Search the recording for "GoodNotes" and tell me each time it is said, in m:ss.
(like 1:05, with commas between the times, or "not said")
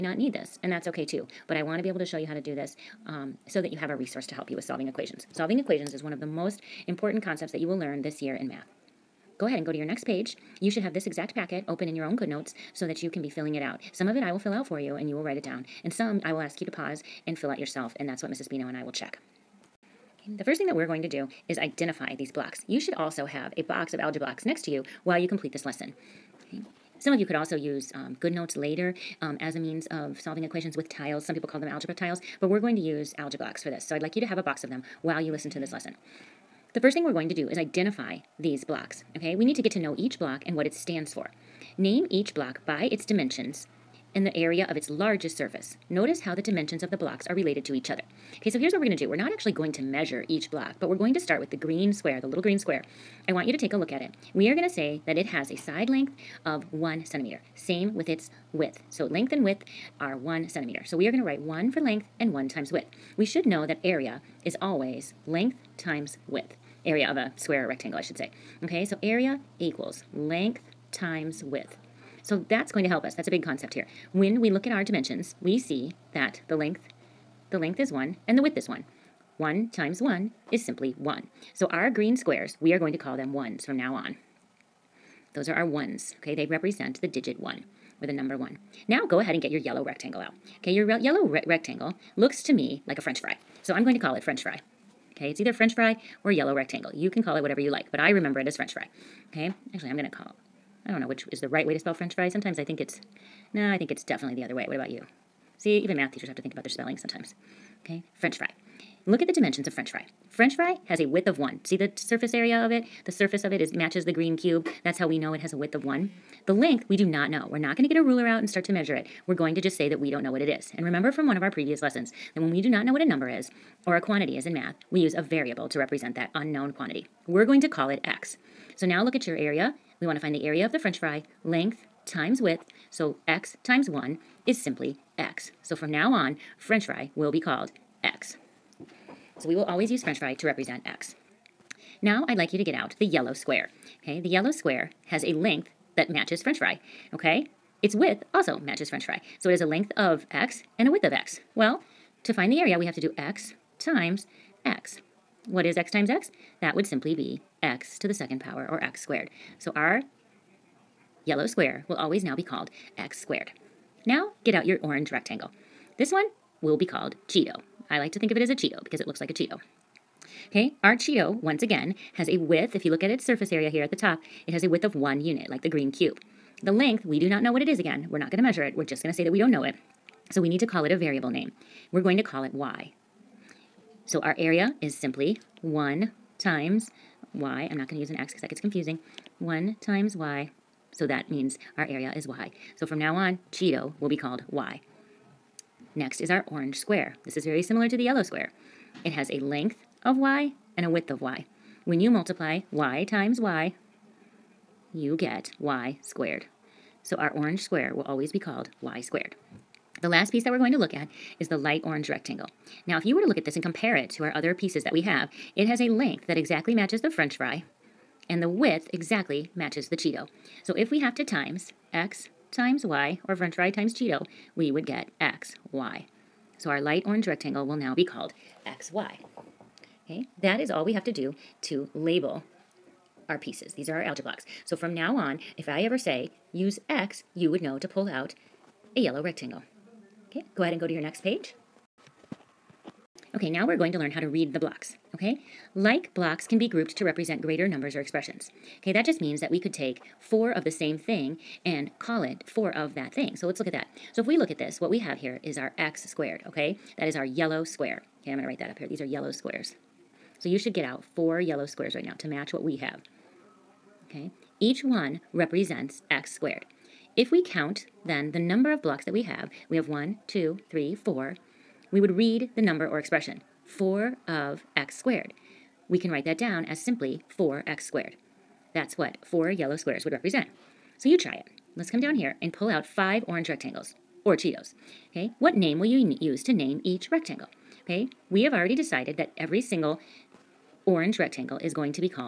0:12, 0:28.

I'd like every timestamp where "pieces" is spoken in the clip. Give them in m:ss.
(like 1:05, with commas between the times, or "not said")
3:30, 3:34, 3:53.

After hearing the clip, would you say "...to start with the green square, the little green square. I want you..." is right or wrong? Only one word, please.
right.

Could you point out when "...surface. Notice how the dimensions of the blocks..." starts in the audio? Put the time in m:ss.
0:45.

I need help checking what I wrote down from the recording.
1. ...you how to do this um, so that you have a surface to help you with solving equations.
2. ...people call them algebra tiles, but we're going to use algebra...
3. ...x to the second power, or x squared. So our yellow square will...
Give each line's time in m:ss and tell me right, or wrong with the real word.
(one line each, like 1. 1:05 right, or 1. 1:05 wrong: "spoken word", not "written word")
1. 0:02 wrong: "resource", not "surface"
2. 0:31 right
3. 2:37 right.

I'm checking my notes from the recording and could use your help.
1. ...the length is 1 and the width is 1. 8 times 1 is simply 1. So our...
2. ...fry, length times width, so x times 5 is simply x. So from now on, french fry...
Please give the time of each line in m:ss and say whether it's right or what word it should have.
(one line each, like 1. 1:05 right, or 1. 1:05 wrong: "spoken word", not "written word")
1. 1:17 wrong: "1", not "8"
2. 2:10 wrong: "1", not "5".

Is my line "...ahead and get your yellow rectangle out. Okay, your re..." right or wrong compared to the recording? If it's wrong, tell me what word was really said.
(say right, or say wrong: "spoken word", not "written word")
right.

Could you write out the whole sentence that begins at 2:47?
I like to think of it as a Cheeto because it looks like a Cheeto.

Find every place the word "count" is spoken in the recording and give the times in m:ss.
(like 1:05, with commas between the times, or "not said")
4:27.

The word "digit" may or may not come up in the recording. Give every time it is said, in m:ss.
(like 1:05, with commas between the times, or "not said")
1:27.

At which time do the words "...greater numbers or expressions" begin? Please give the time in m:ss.
4:07.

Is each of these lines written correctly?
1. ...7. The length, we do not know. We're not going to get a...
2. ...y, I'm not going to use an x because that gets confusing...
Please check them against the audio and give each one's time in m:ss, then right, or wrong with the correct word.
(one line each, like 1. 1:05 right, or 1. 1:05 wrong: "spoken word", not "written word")
1. 1:55 wrong: "1", not "7"
2. 3:07 right.